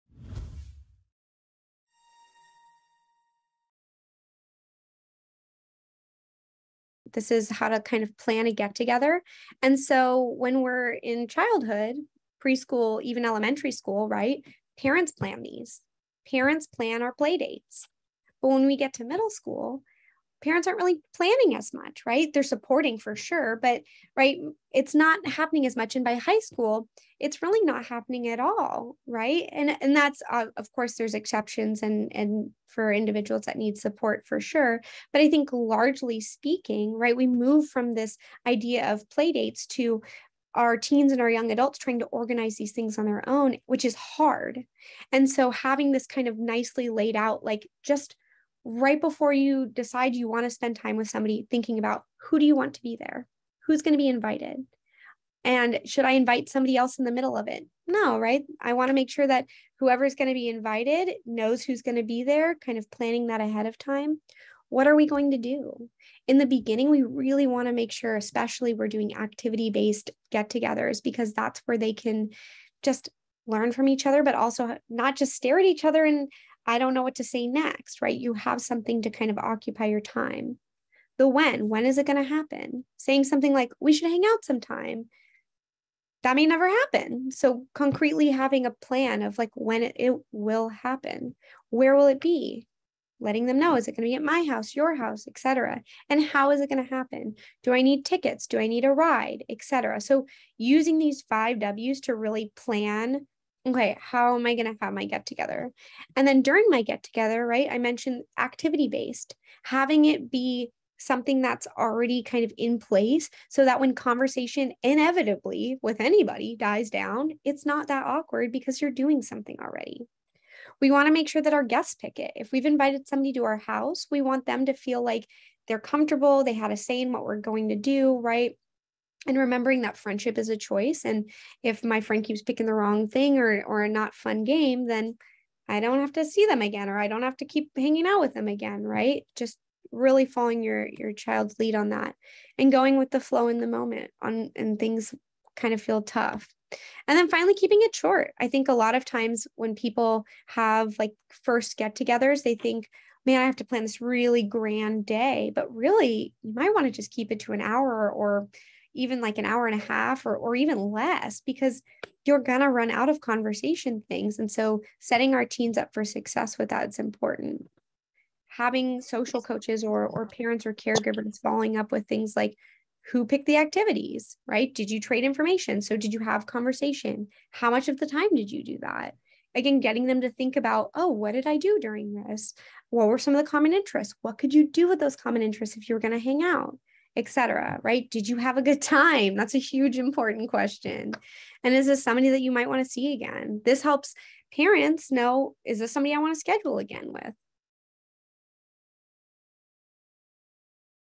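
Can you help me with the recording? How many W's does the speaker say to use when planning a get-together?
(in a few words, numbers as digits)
5.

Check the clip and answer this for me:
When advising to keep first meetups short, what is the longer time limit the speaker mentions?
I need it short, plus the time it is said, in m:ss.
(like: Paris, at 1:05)
An hour and a half, at 2:39.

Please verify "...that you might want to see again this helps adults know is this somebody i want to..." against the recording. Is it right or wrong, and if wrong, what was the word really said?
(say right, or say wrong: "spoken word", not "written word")
wrong: "parents", not "adults".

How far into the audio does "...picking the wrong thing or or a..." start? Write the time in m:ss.
2:12.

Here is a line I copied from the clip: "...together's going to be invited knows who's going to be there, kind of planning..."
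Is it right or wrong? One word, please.
wrong.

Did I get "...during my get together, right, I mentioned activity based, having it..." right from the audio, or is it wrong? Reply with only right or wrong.
right.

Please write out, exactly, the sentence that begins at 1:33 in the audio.
Letting them know, is it going to be at my house, your house, etc.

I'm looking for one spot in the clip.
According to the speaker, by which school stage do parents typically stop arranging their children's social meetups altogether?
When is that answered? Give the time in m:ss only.
0:26.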